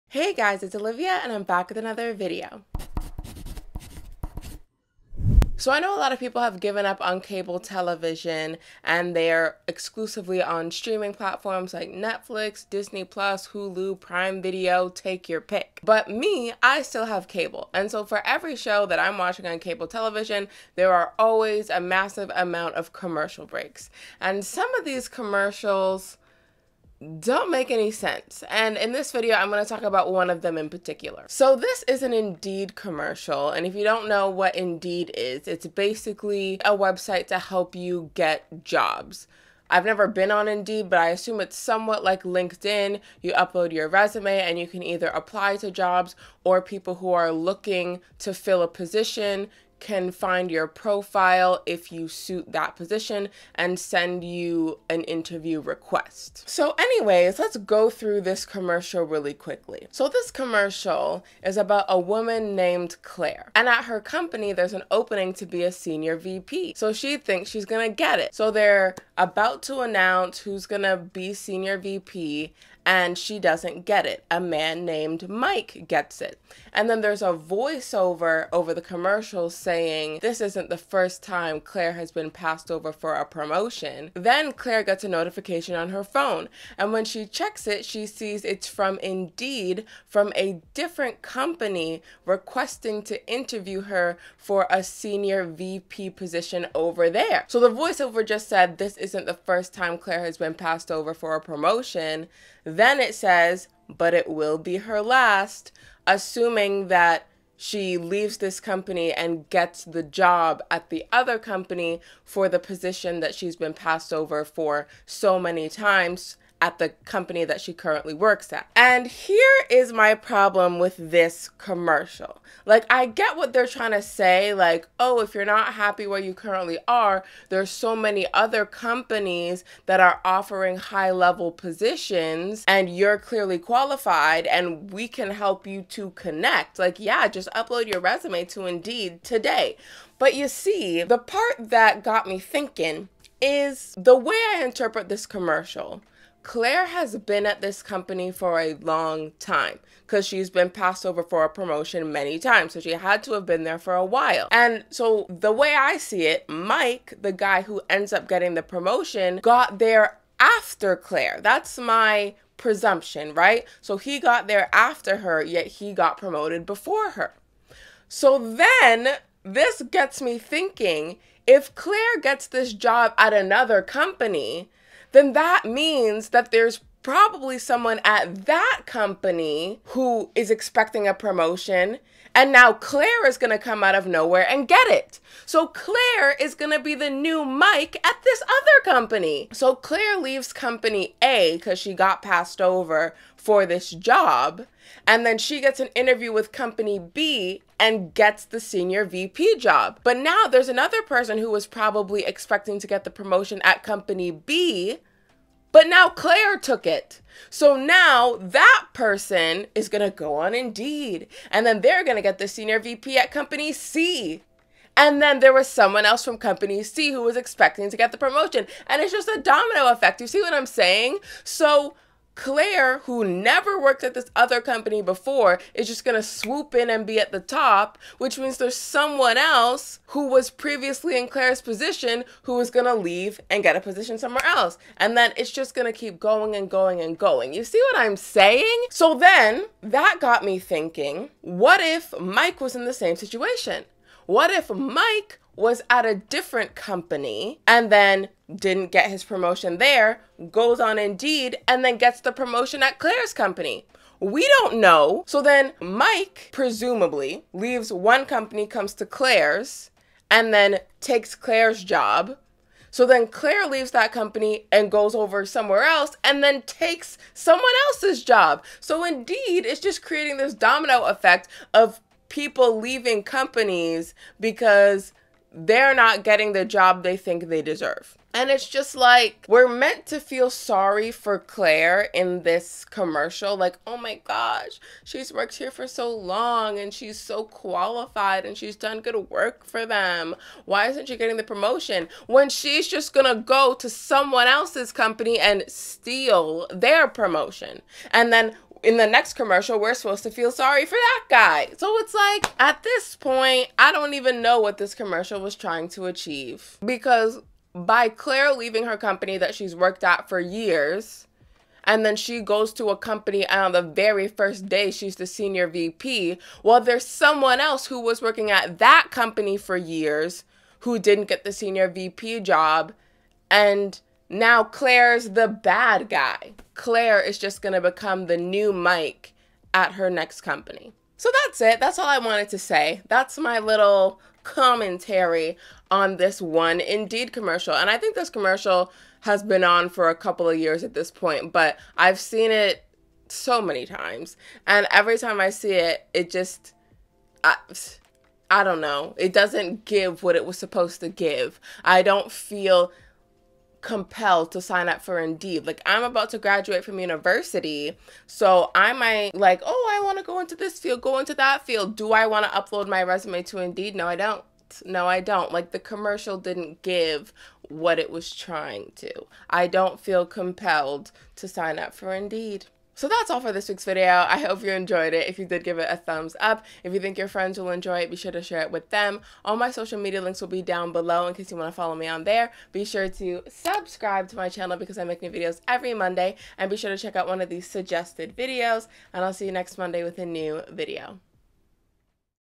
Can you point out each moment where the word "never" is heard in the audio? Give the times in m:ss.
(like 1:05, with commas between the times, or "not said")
0:39, 3:43.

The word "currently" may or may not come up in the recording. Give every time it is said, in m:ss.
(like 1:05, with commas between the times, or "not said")
1:57, 2:06.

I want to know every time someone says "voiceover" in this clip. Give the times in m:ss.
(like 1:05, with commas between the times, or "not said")
1:17, 1:37.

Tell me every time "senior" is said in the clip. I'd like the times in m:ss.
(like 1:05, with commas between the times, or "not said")
1:05, 1:11, 1:34, 3:18, 3:32, 5:15, 5:21.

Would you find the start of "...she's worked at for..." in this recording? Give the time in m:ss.
5:09.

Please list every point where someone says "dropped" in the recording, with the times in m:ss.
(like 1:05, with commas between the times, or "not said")
not said.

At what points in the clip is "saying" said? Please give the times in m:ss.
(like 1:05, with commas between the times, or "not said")
1:19, 3:40, 3:58.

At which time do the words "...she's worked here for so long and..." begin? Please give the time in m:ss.
4:45.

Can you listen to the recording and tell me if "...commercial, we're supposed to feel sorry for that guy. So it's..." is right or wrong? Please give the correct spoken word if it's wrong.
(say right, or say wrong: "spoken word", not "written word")
right.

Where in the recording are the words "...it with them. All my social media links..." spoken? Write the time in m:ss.
6:18.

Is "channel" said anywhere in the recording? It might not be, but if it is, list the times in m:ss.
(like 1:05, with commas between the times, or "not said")
6:24.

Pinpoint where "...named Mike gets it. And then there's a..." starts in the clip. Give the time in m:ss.
1:14.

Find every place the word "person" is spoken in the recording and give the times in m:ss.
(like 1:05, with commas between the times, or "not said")
3:21, 3:28.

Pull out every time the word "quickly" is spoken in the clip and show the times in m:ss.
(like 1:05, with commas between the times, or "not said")
0:59.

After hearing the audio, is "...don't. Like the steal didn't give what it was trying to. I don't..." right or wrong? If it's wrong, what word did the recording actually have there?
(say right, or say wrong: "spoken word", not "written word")
wrong: "commercial", not "steal".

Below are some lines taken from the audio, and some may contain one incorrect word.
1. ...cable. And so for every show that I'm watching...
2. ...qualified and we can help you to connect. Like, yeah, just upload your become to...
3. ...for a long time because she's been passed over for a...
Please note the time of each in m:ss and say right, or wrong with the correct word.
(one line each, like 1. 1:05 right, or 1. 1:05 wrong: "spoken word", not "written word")
1. 0:17 right
2. 2:13 wrong: "resume", not "become"
3. 2:28 right.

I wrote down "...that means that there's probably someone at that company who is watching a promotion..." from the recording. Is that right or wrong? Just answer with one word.
wrong.